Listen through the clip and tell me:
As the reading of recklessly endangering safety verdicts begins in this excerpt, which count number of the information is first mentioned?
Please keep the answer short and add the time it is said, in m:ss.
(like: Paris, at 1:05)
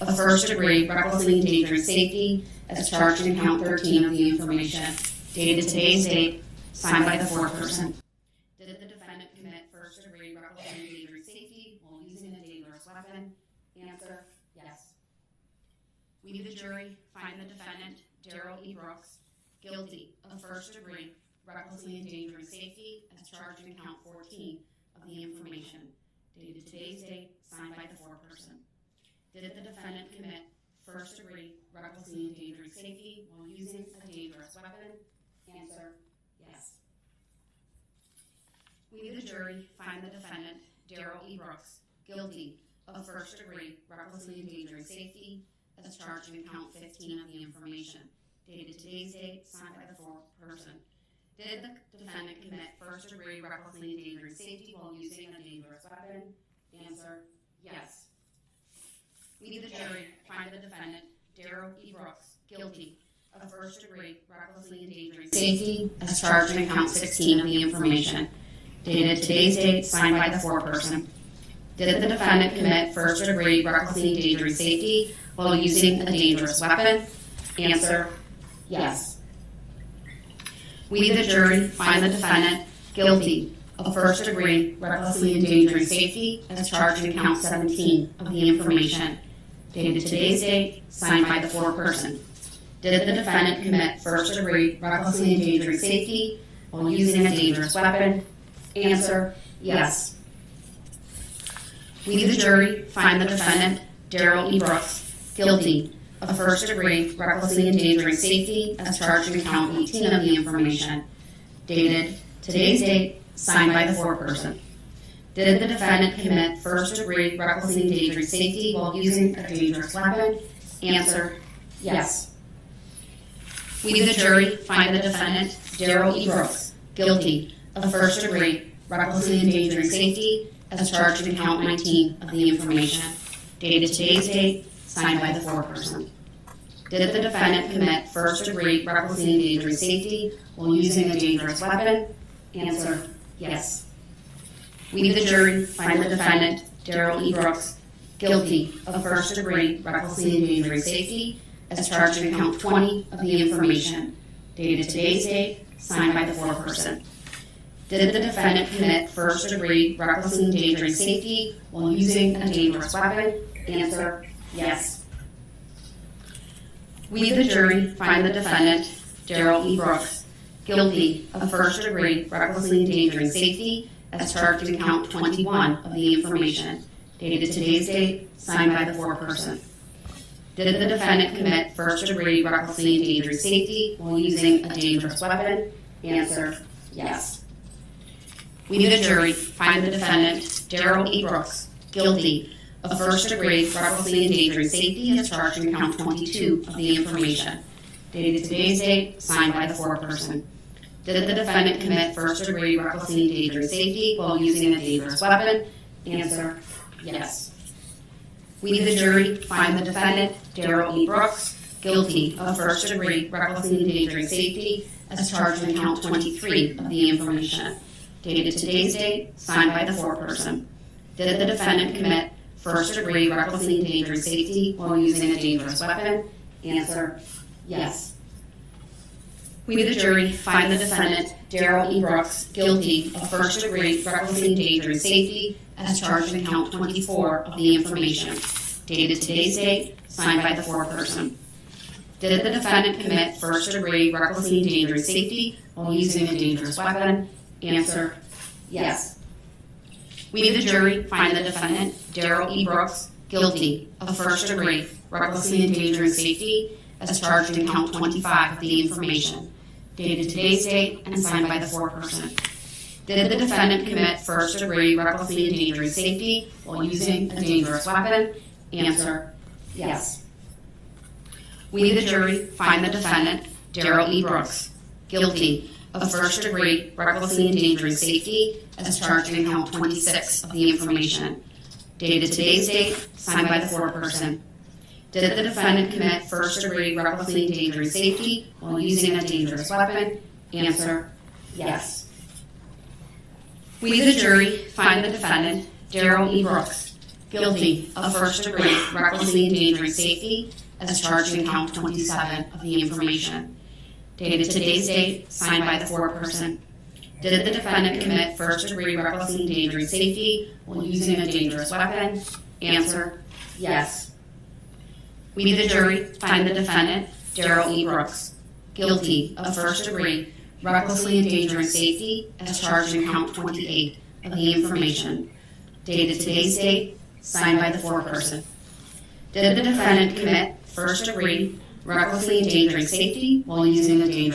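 13, at 0:03.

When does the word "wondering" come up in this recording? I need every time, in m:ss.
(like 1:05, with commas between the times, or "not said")
not said.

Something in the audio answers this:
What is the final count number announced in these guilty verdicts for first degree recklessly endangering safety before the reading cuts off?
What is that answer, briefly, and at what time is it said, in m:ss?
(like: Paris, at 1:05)
28, at 5:23.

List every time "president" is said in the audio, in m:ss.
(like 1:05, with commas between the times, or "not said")
not said.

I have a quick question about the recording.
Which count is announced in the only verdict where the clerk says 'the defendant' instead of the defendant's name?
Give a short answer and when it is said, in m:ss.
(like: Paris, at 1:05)
17, at 1:27.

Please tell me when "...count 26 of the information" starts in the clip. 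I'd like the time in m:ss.
4:39.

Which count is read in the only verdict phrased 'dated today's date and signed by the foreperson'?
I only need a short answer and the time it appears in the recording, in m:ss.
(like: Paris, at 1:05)
25, at 4:17.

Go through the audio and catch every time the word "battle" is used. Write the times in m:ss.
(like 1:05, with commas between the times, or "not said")
not said.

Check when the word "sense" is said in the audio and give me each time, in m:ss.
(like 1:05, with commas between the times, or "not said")
not said.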